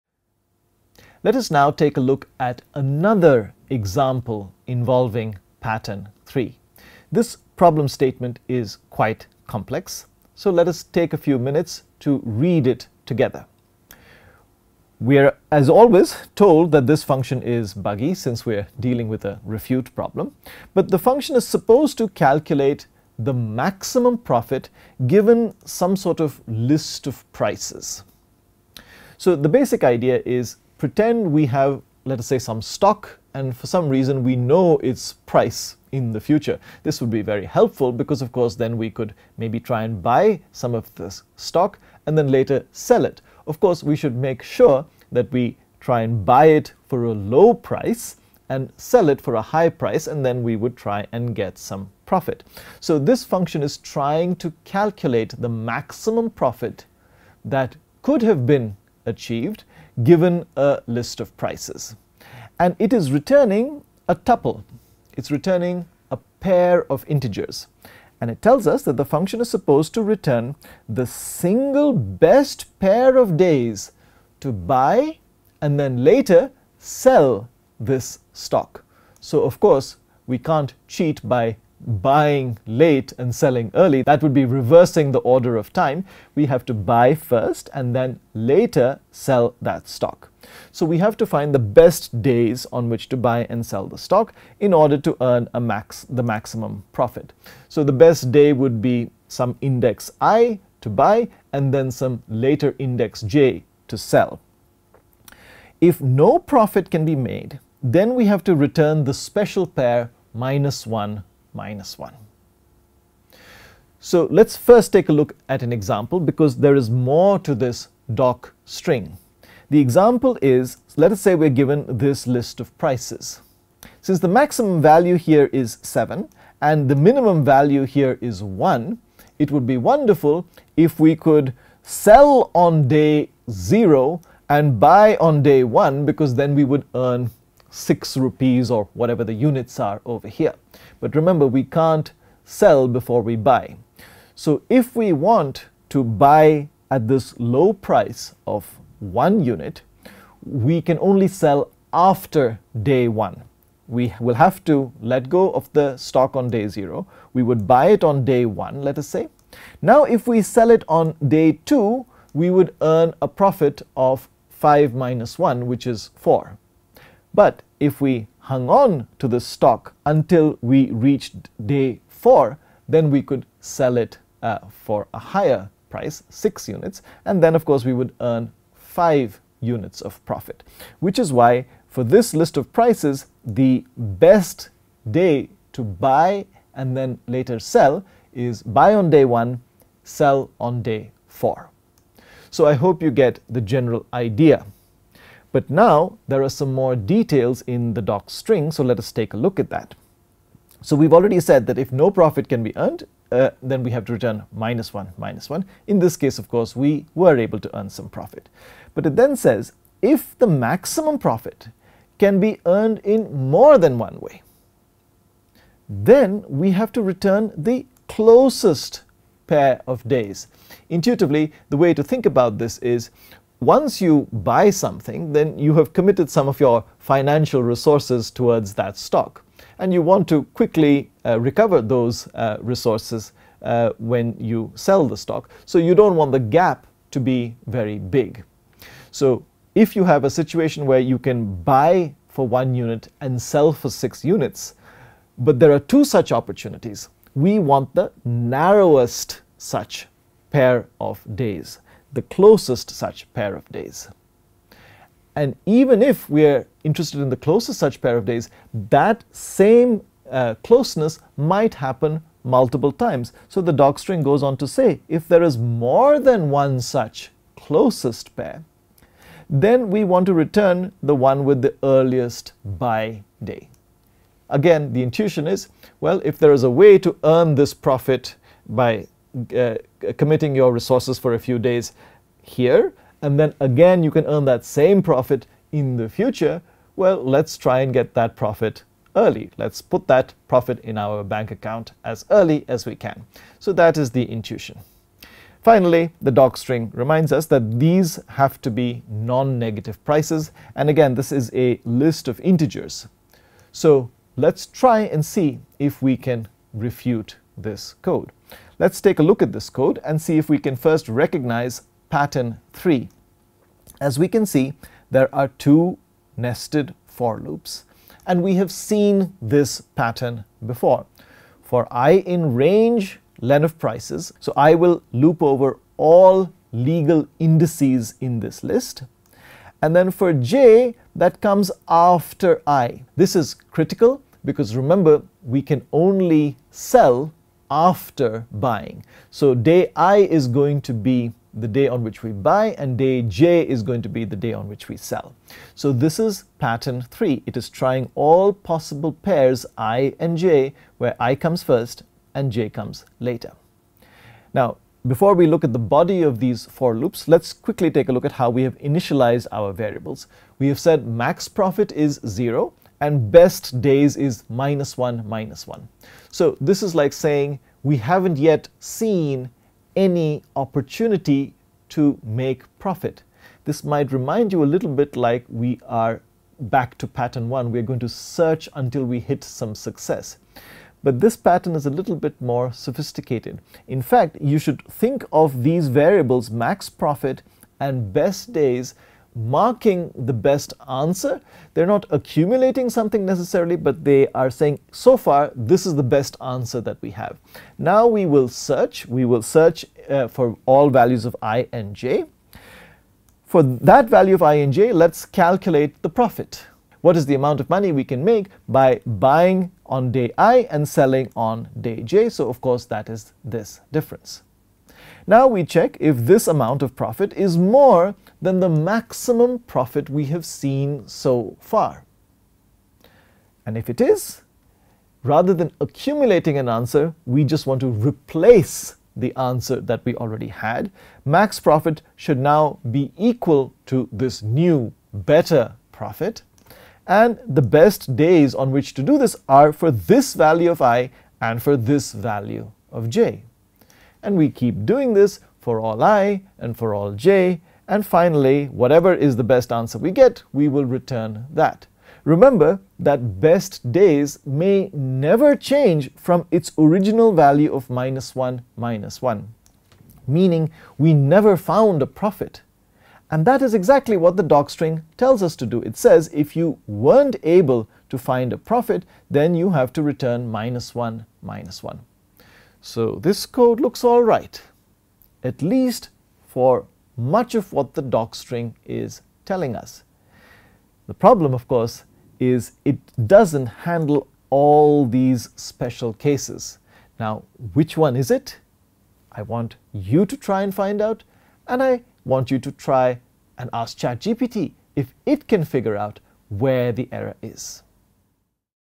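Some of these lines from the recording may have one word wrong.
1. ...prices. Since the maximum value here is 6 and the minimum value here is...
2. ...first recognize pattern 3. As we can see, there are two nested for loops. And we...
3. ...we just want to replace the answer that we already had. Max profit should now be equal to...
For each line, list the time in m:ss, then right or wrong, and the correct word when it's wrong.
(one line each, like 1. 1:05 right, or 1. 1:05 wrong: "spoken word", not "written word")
1. 2:02 wrong: "7", not "6"
2. 5:10 right
3. 7:07 right.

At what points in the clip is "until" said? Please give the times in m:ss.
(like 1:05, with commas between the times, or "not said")
2:50, 6:18.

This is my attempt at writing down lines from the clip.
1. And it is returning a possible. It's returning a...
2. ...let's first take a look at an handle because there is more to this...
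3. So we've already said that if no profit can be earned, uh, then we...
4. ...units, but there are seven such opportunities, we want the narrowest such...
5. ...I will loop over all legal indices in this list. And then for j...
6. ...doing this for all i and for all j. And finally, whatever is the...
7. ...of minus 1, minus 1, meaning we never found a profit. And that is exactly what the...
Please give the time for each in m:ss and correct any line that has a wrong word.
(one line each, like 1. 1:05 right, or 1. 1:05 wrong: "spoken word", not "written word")
1. 1:02 wrong: "tuple", not "possible"
2. 1:54 wrong: "example", not "handle"
3. 3:20 right
4. 4:04 wrong: "two", not "seven"
5. 5:24 right
6. 7:24 right
7. 7:37 right.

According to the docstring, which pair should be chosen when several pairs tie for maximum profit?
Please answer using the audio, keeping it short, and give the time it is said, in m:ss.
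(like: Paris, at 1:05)
earliest buy day, at 4:31.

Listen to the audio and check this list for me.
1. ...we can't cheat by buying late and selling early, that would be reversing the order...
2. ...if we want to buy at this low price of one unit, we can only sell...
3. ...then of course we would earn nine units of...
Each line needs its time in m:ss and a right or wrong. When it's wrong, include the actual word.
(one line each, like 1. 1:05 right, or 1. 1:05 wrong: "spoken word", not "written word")
1. 1:20 right
2. 2:24 right
3. 2:57 wrong: "five", not "nine".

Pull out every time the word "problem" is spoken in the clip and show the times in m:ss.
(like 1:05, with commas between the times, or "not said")
0:07, 0:19, 8:01.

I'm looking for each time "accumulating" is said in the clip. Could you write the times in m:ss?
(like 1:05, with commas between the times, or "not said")
6:32, 7:05.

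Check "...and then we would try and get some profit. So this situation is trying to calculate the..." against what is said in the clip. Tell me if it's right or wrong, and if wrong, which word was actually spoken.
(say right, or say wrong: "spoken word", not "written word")
wrong: "function", not "situation".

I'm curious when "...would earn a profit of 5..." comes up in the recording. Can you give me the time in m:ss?
2:42.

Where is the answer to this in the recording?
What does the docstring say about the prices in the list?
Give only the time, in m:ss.
4:59.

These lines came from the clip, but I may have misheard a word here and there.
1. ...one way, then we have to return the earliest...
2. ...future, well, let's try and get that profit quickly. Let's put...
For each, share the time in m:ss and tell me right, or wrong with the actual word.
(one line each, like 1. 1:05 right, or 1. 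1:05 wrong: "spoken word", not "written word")
1. 3:33 wrong: "closest", not "earliest"
2. 4:46 wrong: "early", not "quickly".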